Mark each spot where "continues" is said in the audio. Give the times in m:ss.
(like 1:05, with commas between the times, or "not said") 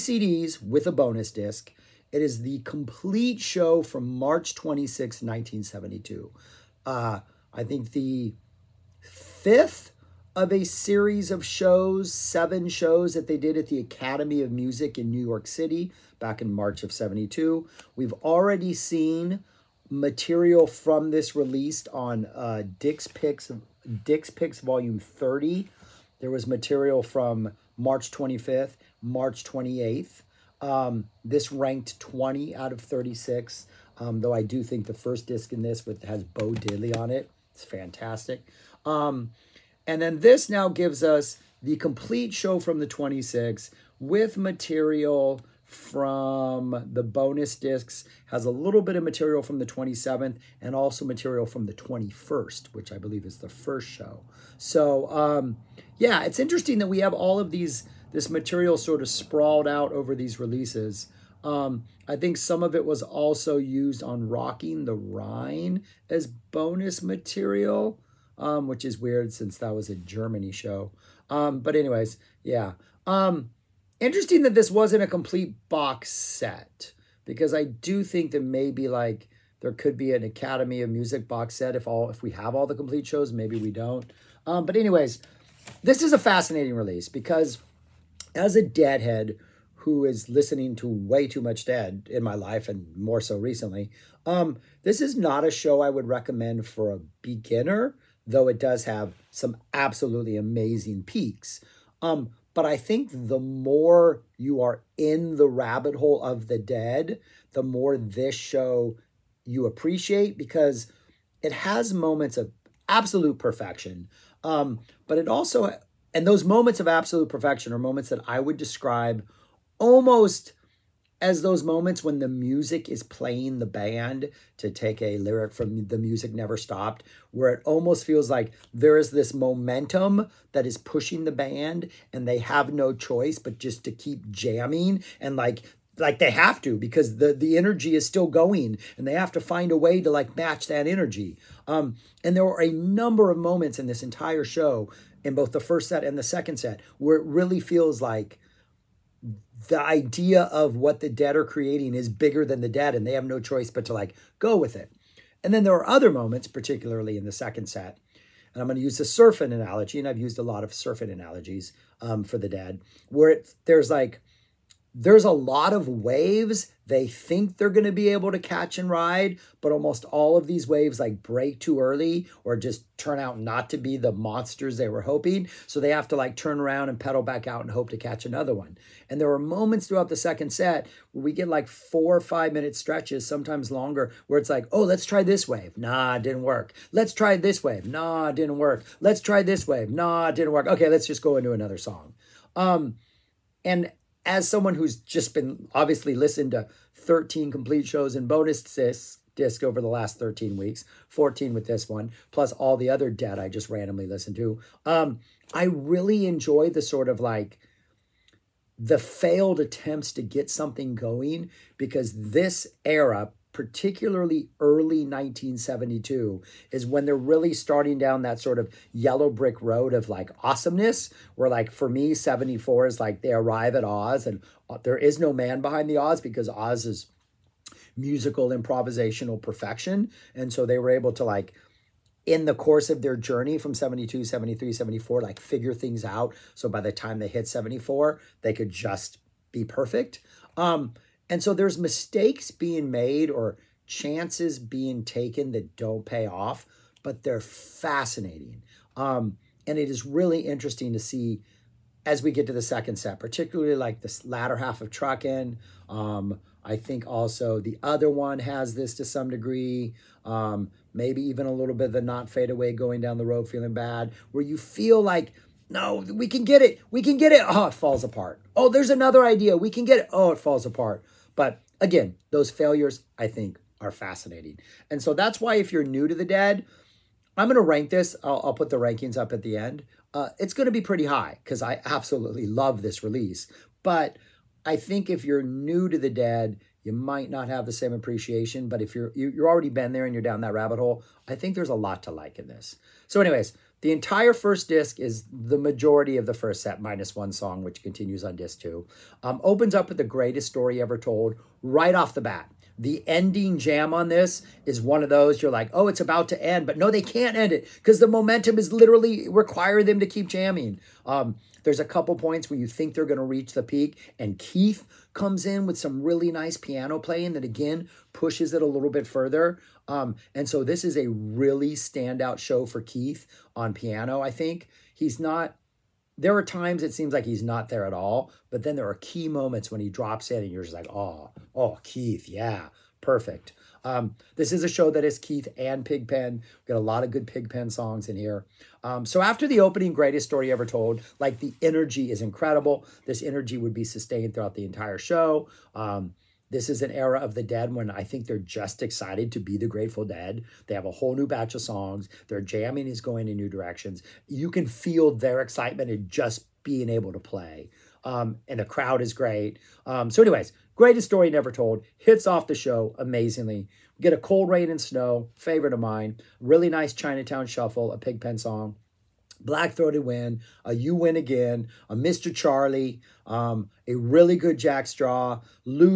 4:57.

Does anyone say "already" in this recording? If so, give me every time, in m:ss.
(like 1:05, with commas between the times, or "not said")
0:18, 4:49.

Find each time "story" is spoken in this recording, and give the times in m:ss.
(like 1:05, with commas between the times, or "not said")
5:00, 5:40, 6:01.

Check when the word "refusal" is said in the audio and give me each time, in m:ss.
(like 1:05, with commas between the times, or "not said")
not said.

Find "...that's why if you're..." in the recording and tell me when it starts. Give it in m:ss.
4:35.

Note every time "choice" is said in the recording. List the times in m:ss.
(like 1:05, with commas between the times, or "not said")
2:12, 2:33.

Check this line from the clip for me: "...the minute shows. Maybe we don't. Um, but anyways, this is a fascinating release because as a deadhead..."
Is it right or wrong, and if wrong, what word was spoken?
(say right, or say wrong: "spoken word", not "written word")
wrong: "complete", not "minute".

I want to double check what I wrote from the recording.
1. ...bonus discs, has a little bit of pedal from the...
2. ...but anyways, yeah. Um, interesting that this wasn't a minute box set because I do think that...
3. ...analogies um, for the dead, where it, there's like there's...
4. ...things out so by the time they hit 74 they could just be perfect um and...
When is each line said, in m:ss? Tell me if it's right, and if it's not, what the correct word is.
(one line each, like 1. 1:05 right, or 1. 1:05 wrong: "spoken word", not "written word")
1. 0:47 wrong: "material", not "pedal"
2. 1:11 wrong: "complete", not "minute"
3. 2:41 right
4. 3:55 right.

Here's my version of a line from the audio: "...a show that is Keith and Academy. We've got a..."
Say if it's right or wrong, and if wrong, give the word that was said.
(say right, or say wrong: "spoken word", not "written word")
wrong: "Pigpen", not "Academy".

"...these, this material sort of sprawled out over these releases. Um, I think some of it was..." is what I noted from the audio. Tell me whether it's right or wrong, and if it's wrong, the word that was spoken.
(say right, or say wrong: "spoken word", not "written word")
right.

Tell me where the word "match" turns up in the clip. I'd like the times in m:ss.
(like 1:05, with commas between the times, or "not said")
2:20.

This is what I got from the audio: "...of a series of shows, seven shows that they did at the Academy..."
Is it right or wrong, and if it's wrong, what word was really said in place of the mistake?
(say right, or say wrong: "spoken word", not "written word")
right.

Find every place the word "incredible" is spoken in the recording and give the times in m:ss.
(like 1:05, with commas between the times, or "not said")
5:42.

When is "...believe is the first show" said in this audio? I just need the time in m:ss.
0:52.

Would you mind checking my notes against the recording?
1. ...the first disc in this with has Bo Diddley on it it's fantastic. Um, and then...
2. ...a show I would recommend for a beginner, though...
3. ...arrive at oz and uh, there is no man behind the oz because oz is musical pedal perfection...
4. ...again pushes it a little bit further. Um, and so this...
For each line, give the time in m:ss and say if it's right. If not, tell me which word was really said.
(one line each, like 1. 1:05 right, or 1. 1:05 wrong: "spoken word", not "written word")
1. 0:34 right
2. 1:35 right
3. 3:43 wrong: "improvisational", not "pedal"
4. 5:17 right.